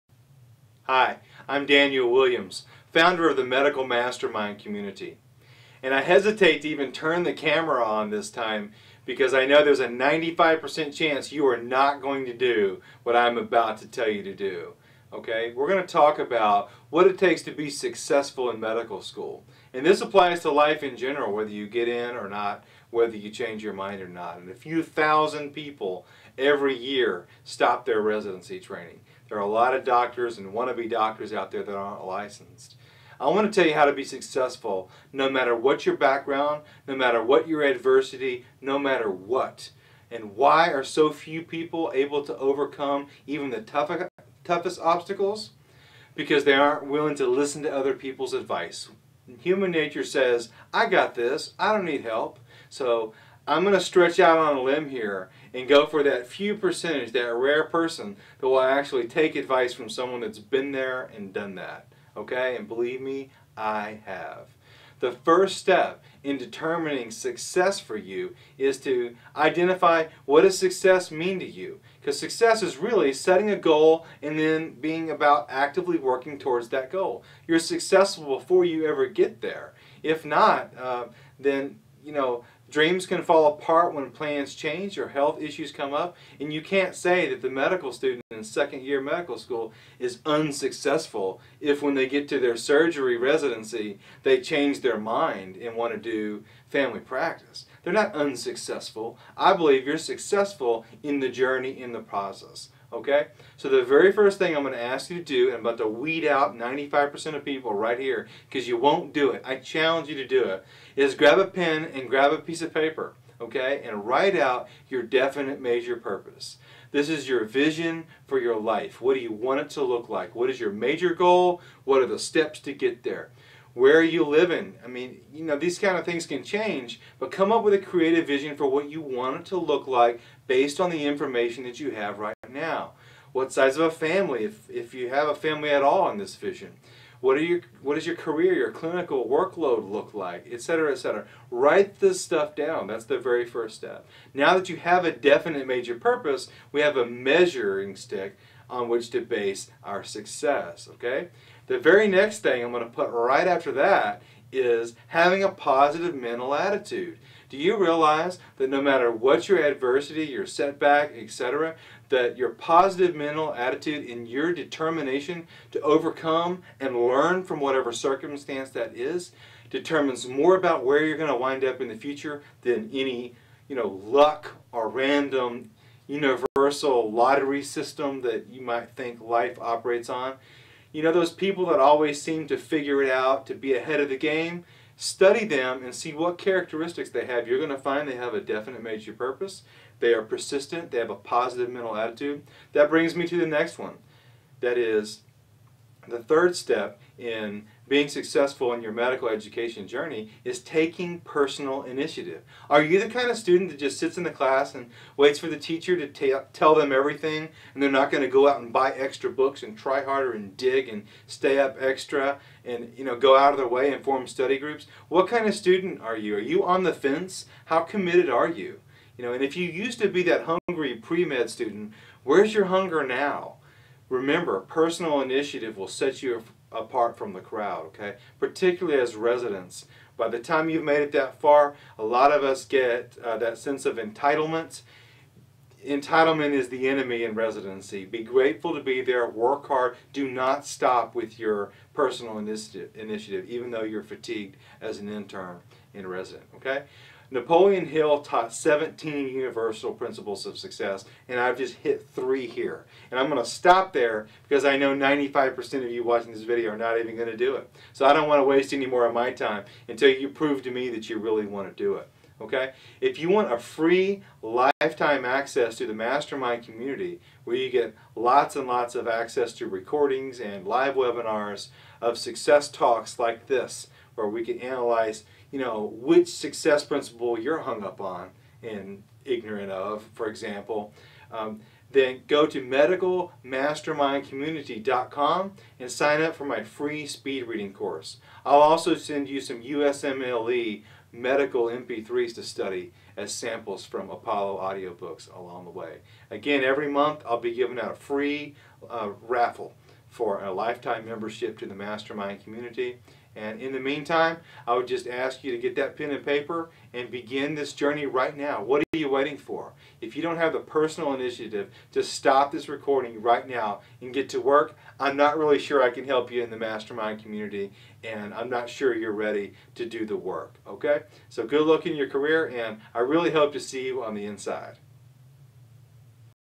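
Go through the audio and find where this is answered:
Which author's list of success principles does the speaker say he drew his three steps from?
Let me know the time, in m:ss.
4:07.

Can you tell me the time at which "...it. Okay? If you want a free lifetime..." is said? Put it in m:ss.
4:21.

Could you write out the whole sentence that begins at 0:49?
Human nature says, I got this, I don't need help.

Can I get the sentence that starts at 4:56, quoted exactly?
Again, every month I'll be giving out a free uh, raffle for a lifetime membership to the mastermind community.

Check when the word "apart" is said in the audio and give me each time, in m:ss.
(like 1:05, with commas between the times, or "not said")
1:23, 3:46.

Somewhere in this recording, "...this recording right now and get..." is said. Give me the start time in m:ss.
5:12.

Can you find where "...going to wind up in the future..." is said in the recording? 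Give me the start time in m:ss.
2:51.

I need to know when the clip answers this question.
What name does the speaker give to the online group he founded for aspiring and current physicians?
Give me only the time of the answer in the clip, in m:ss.
0:03.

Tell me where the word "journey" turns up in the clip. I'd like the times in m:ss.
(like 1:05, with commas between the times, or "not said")
1:41, 3:19, 5:07.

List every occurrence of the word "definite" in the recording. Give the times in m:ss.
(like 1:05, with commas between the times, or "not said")
1:55, 2:25, 3:08.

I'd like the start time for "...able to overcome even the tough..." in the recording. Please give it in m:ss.
0:41.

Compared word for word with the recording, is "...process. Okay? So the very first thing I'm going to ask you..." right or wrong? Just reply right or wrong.
right.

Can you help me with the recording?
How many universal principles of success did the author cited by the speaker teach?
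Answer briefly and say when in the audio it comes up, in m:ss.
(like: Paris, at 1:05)
17, at 4:08.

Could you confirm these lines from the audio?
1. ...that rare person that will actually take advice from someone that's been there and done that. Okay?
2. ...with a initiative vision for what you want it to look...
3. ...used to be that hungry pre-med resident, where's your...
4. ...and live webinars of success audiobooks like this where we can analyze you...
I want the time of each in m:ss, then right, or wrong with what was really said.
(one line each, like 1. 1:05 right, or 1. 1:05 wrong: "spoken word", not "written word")
1. 0:57 right
2. 2:07 wrong: "creative", not "initiative"
3. 3:39 wrong: "student", not "resident"
4. 4:30 wrong: "talks", not "audiobooks".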